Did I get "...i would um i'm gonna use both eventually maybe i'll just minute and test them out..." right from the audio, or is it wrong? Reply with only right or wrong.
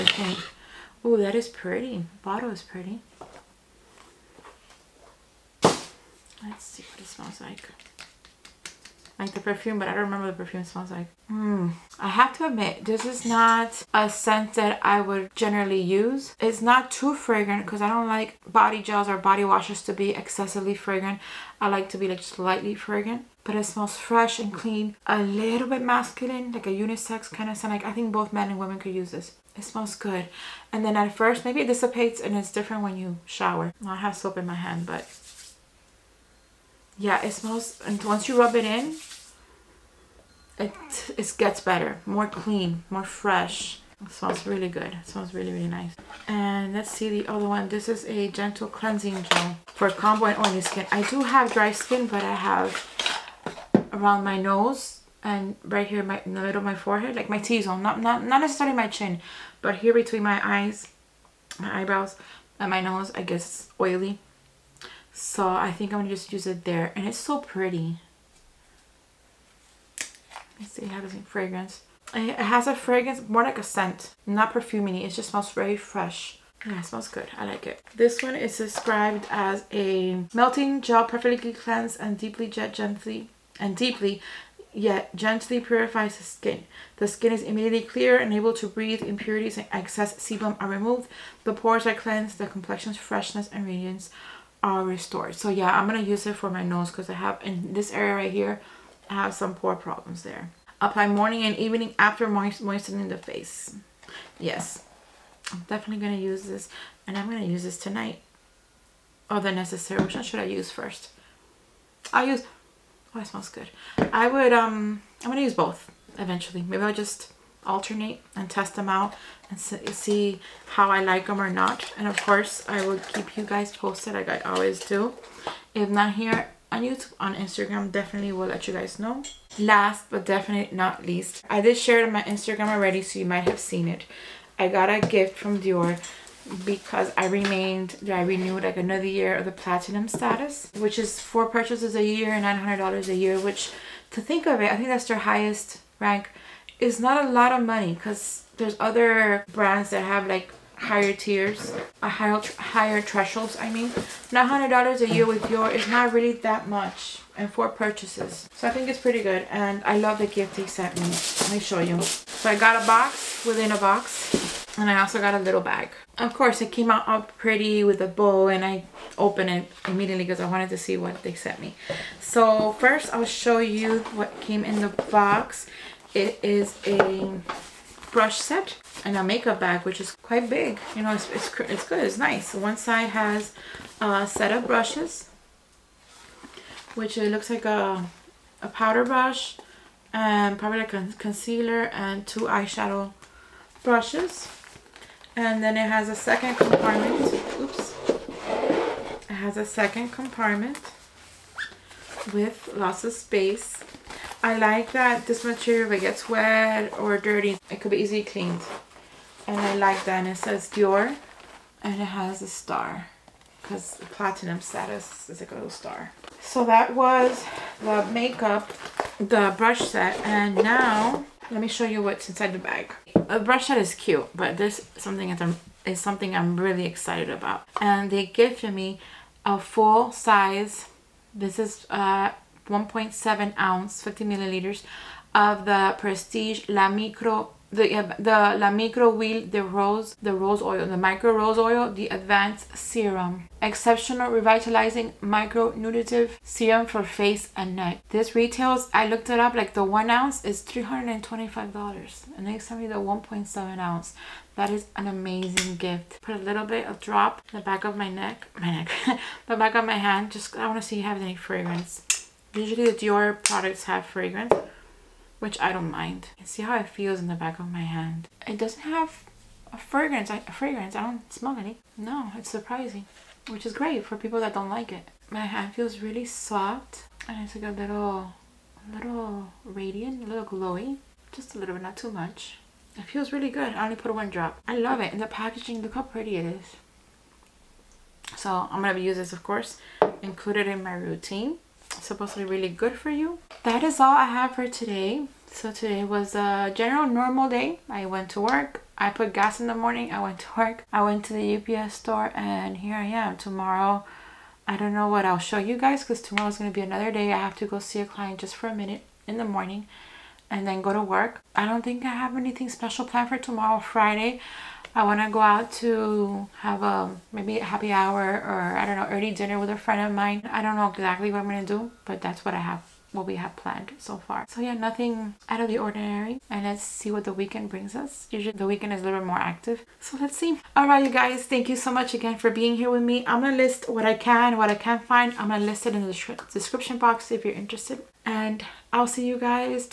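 wrong.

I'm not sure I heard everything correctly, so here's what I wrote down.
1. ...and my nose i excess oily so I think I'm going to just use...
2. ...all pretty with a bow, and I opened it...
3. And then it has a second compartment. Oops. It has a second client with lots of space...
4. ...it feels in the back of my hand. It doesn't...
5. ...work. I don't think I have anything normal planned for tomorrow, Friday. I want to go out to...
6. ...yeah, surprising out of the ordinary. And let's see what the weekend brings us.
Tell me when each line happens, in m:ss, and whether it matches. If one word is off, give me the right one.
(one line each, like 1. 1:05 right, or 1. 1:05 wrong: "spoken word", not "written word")
1. 1:02 wrong: "guess", not "excess"
2. 2:47 right
3. 3:15 wrong: "compartment", not "client"
4. 4:26 right
5. 5:11 wrong: "special", not "normal"
6. 5:24 wrong: "nothing", not "surprising".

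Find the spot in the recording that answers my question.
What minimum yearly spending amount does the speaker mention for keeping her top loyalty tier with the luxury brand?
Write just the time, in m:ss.
2:22.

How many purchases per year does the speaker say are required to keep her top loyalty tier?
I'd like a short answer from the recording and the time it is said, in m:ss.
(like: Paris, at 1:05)
4, at 2:21.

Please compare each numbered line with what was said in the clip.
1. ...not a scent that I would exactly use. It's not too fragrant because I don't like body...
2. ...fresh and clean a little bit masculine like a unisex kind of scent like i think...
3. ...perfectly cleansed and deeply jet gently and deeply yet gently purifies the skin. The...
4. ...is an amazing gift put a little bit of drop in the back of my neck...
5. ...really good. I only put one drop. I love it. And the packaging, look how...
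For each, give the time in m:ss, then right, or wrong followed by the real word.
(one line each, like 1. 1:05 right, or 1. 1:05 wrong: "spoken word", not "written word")
1. 0:13 wrong: "generally", not "exactly"
2. 0:23 right
3. 1:21 right
4. 4:14 right
5. 4:43 right.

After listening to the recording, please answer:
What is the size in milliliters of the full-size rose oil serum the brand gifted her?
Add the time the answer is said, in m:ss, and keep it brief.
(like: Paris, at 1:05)
50 milliliters, at 3:54.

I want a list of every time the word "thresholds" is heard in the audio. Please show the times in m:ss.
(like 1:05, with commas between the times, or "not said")
2:33.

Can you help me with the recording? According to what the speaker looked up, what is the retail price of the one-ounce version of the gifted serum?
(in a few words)
$325.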